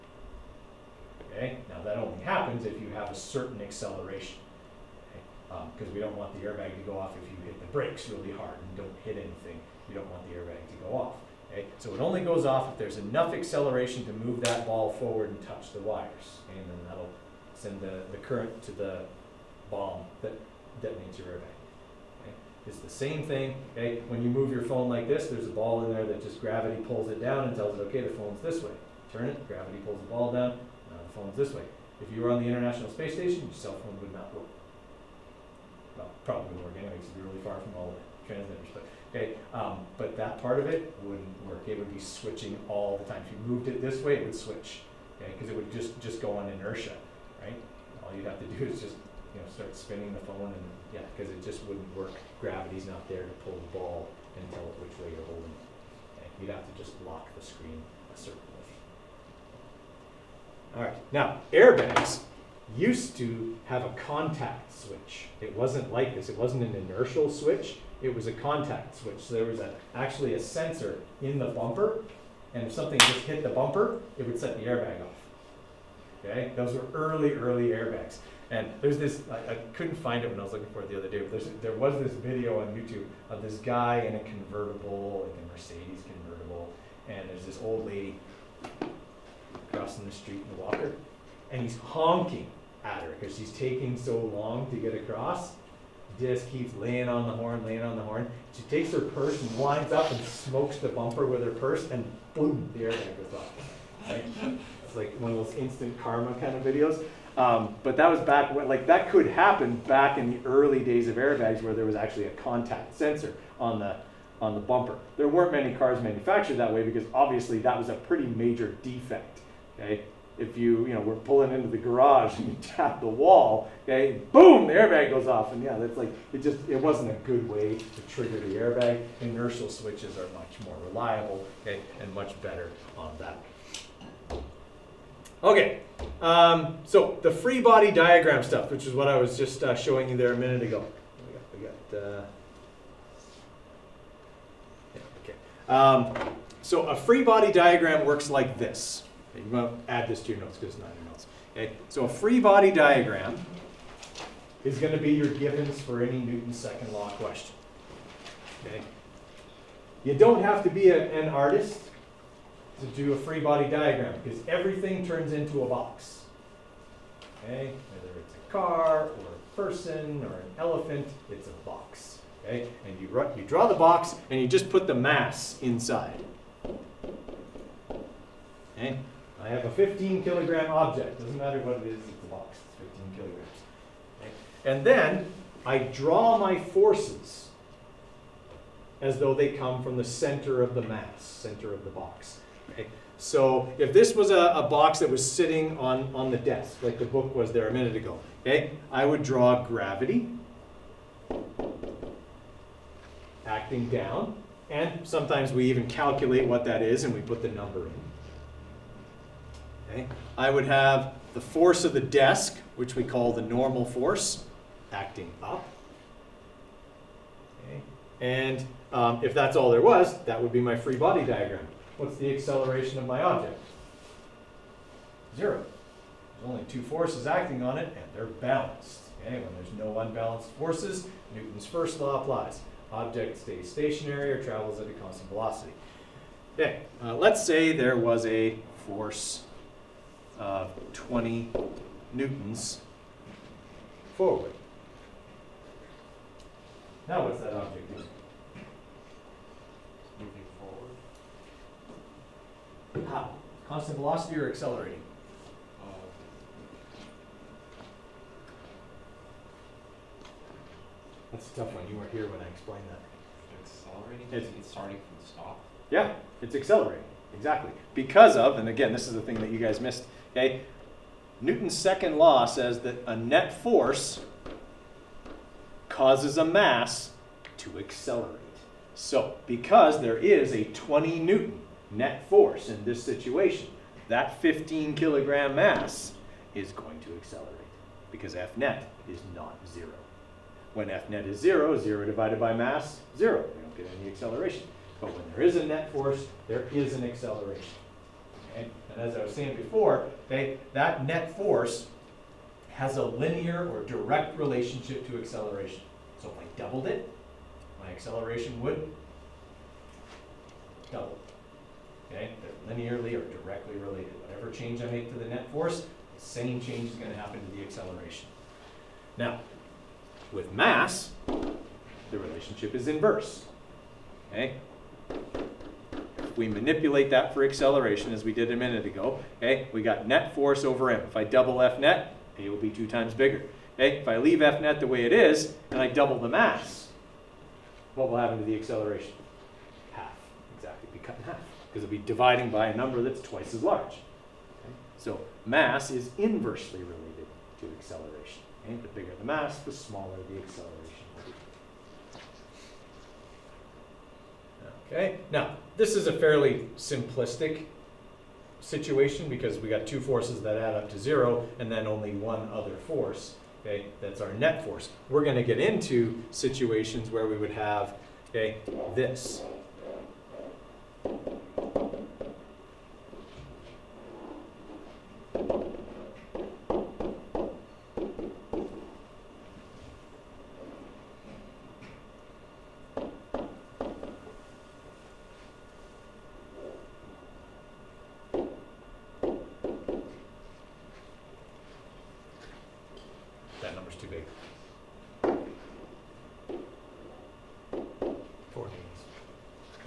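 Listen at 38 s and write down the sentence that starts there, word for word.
But, okay, um, but that part of it wouldn't work.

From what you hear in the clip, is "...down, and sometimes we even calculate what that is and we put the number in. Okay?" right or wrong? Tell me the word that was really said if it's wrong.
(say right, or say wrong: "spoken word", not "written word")
right.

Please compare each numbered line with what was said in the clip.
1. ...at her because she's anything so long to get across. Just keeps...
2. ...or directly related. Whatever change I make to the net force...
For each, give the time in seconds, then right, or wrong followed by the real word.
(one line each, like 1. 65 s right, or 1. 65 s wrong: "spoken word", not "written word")
1. 92 s wrong: "taking", not "anything"
2. 313 s right.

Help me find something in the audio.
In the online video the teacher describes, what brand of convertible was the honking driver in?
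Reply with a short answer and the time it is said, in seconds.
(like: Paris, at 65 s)
Mercedes, at 85 s.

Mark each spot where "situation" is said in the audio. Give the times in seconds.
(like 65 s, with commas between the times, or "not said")
283 s, 358 s, 366 s.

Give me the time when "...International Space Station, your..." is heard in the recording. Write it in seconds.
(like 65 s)
32 s.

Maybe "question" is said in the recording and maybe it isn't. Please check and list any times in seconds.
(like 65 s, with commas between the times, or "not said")
157 s.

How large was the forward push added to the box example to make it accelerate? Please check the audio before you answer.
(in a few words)
20 newtons.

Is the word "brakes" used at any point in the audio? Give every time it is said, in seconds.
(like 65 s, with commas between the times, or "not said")
7 s.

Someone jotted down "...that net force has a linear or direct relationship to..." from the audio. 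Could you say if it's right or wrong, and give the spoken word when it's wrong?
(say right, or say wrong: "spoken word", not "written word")
right.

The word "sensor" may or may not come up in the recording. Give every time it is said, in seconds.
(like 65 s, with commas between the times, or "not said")
70 s, 112 s.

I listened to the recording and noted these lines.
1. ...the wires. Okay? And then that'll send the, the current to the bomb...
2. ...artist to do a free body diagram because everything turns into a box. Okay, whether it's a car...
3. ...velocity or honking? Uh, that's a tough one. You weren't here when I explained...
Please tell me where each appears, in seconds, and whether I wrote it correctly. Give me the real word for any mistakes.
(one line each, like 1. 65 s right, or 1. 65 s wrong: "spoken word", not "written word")
1. 15 s right
2. 161 s right
3. 253 s wrong: "accelerating", not "honking".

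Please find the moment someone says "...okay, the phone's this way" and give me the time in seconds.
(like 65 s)
27 s.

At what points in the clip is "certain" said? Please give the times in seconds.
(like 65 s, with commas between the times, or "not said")
3 s, 58 s.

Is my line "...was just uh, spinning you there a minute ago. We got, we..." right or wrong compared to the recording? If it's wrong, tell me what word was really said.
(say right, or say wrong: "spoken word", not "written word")
wrong: "showing", not "spinning".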